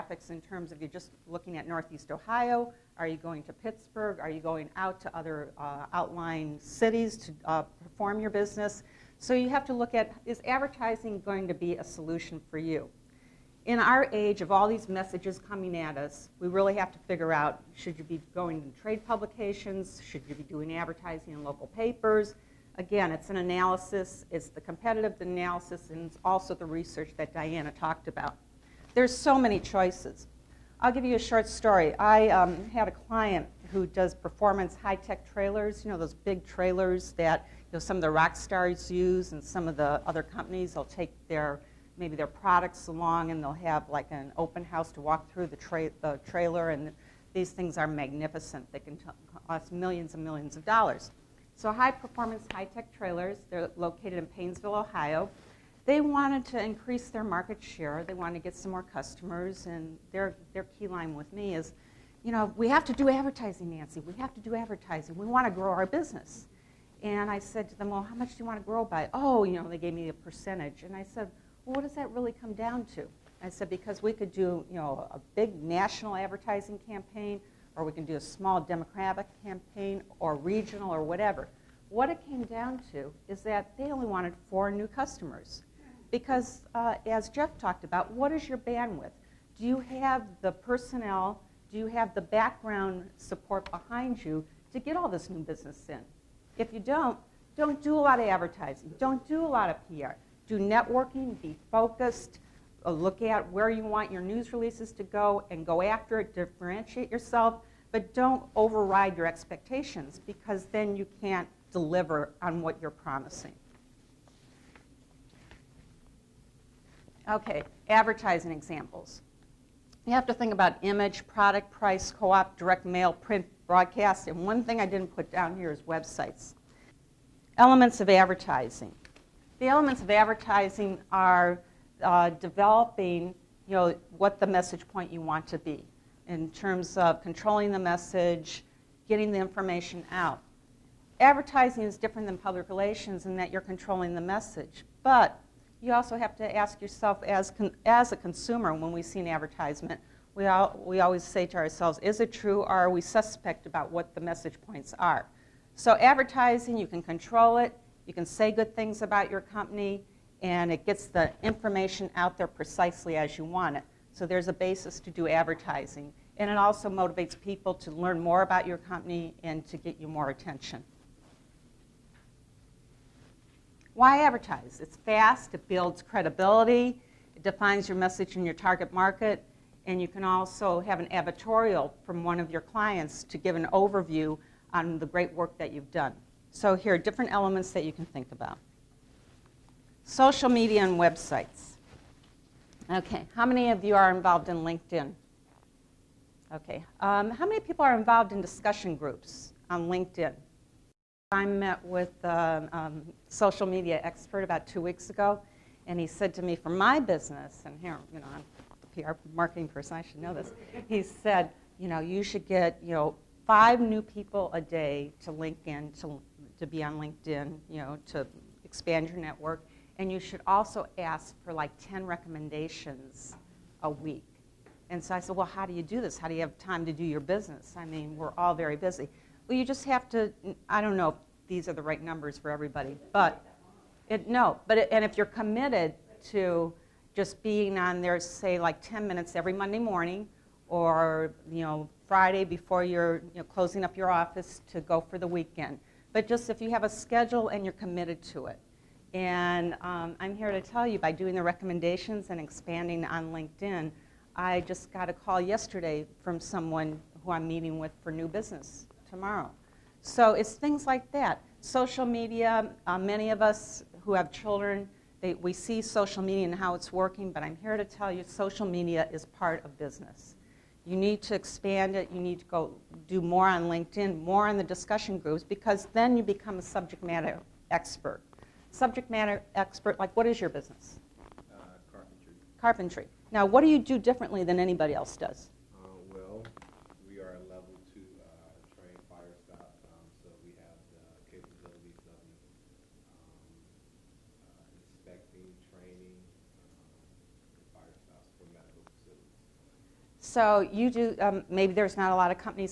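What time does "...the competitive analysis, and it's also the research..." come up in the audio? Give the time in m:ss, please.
0:24.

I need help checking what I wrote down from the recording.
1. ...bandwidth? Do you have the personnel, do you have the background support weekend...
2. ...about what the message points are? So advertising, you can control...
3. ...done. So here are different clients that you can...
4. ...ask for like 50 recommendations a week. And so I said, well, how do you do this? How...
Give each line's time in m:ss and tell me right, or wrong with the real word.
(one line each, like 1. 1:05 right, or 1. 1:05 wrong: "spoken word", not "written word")
1. 1:28 wrong: "behind", not "weekend"
2. 2:33 right
3. 3:05 wrong: "elements", not "clients"
4. 3:40 wrong: "10", not "50".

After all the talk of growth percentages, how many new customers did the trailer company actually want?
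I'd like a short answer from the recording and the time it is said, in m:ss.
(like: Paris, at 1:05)
4, at 1:24.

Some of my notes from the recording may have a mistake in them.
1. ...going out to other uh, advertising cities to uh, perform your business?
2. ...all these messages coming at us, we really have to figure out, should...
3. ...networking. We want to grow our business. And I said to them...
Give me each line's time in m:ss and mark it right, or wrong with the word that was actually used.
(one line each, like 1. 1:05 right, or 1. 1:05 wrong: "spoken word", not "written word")
1. 0:04 wrong: "outlying", not "advertising"
2. 0:14 right
3. 1:04 wrong: "advertising", not "networking".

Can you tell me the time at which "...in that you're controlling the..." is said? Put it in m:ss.
2:23.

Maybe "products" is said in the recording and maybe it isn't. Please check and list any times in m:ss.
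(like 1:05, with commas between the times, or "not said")
0:42, 2:01.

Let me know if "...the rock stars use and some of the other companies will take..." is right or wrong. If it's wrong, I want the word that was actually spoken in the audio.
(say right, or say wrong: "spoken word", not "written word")
right.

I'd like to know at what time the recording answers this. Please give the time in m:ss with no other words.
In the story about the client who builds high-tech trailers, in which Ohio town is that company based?
0:54.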